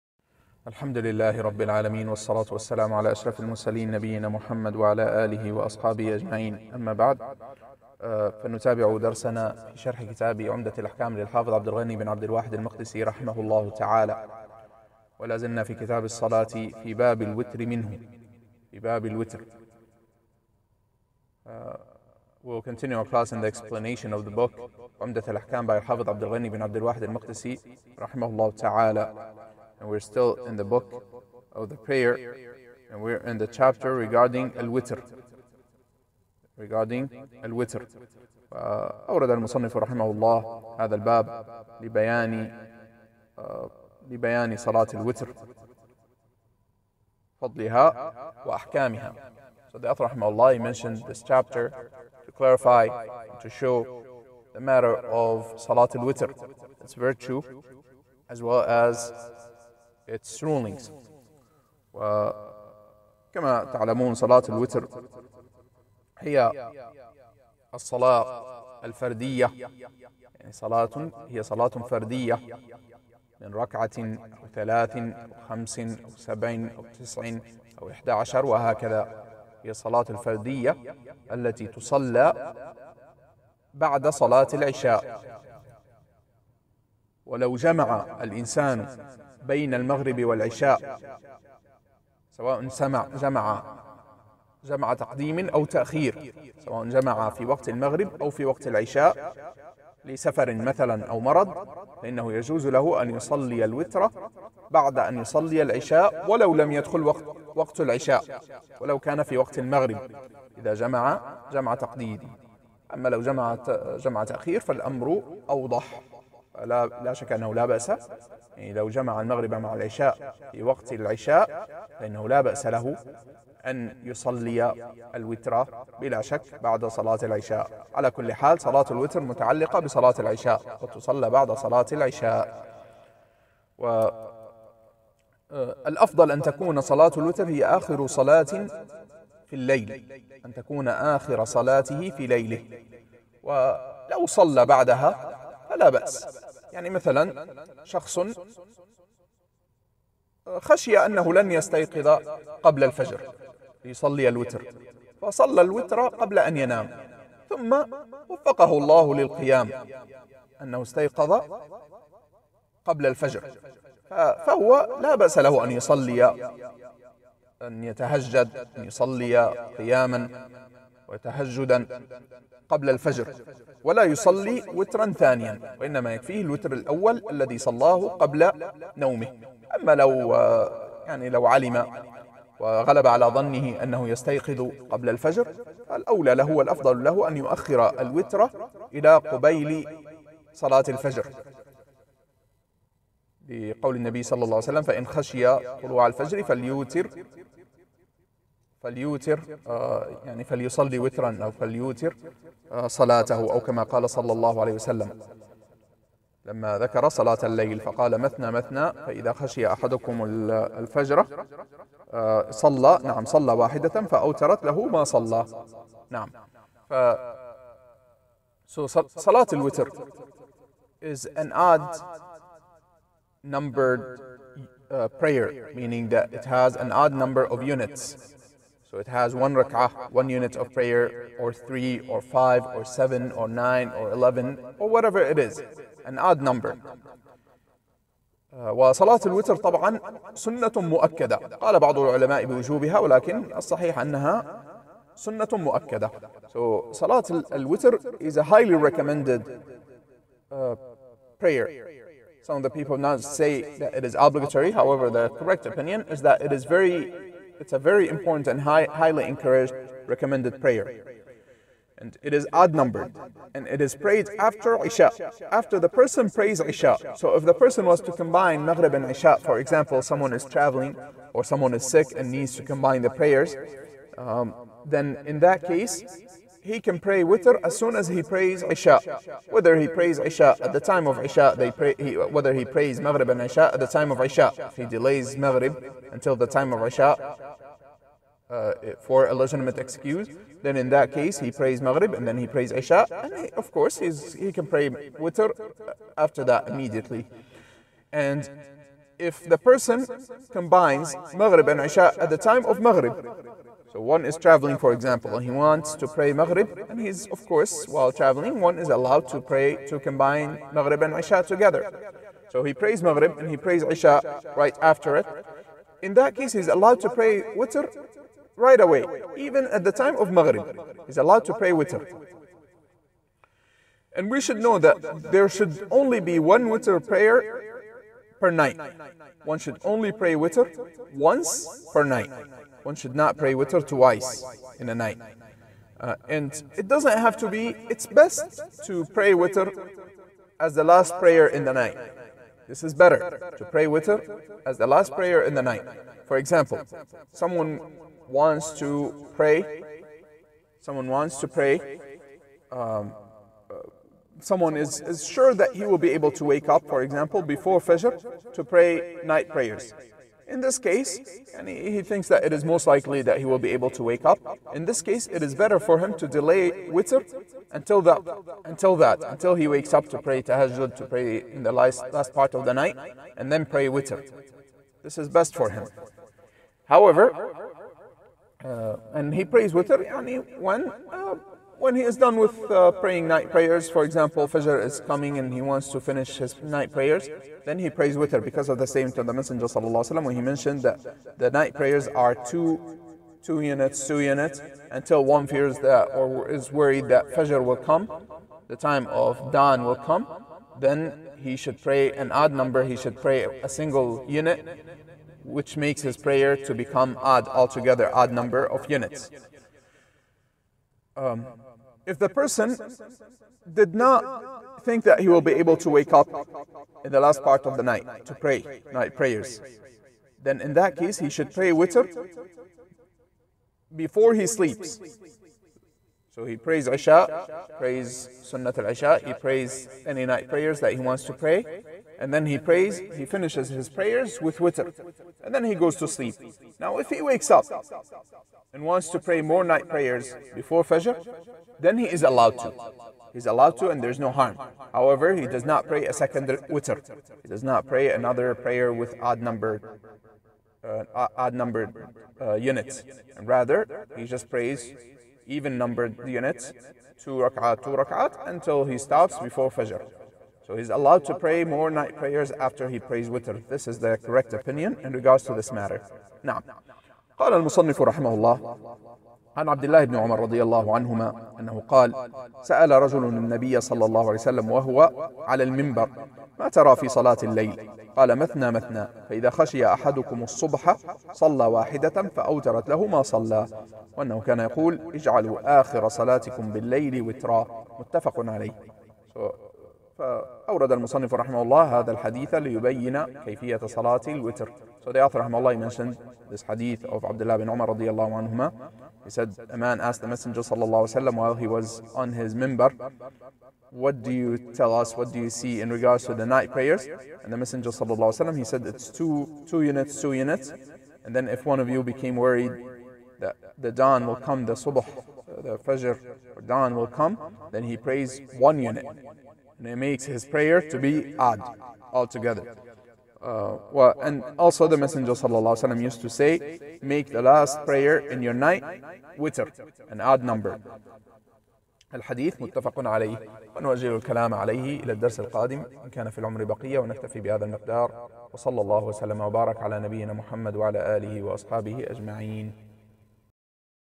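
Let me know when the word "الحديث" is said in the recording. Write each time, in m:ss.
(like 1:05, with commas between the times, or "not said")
8:12, 8:52.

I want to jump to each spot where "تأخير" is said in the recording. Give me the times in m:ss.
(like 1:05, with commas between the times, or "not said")
1:35, 1:54.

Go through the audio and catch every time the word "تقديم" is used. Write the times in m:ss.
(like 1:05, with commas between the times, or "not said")
1:34, 1:51.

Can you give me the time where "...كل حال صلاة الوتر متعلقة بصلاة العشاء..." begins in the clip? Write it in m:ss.
2:08.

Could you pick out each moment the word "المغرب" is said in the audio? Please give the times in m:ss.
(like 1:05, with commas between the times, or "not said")
1:29, 1:37, 1:49, 1:59.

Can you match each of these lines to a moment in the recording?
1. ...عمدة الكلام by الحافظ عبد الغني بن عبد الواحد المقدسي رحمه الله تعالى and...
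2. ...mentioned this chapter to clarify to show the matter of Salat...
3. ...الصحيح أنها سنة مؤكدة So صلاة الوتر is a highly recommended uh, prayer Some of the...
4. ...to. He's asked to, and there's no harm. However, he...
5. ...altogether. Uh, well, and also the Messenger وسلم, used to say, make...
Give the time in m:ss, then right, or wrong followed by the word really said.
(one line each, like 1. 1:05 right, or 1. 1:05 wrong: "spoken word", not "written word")
1. 0:25 wrong: "الأحكام", not "الكلام"
2. 0:50 right
3. 4:03 right
4. 7:22 wrong: "allowed", not "asked"
5. 8:42 right.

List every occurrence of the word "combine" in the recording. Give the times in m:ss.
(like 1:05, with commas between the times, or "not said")
4:28, 4:32, 5:00, 5:09.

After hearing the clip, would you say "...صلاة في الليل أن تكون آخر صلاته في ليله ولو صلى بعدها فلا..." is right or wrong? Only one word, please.
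right.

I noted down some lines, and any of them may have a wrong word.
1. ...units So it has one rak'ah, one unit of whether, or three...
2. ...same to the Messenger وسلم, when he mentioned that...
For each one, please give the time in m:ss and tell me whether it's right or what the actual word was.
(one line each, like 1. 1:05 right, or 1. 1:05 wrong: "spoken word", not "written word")
1. 3:47 wrong: "prayer", not "whether"
2. 6:28 right.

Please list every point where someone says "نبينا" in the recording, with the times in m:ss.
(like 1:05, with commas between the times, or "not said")
0:03, 8:59.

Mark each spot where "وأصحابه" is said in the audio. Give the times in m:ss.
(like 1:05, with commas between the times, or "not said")
0:05, 9:01.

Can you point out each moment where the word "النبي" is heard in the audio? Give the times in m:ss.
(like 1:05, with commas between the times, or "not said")
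3:13, 7:53.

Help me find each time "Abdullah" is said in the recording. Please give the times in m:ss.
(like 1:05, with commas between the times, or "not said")
8:17.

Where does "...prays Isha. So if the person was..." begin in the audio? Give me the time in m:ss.
4:26.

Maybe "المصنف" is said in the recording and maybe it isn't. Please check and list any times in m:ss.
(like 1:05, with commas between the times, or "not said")
0:39, 7:47, 8:10.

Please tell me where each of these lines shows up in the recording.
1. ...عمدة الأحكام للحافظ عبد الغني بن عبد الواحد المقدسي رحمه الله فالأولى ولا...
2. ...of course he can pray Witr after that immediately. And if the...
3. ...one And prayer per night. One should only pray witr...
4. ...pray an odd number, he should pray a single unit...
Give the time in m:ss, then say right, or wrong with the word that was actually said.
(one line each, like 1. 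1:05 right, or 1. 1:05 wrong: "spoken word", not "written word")
1. 0:10 wrong: "تعالى", not "فالأولى"
2. 4:53 right
3. 5:26 wrong: "Witr", not "And"
4. 6:41 right.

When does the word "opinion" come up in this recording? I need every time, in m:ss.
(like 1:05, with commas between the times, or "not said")
4:15, 7:44.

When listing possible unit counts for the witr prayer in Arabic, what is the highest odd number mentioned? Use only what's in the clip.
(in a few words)
11.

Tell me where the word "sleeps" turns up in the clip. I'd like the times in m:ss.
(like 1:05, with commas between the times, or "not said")
7:04, 7:16.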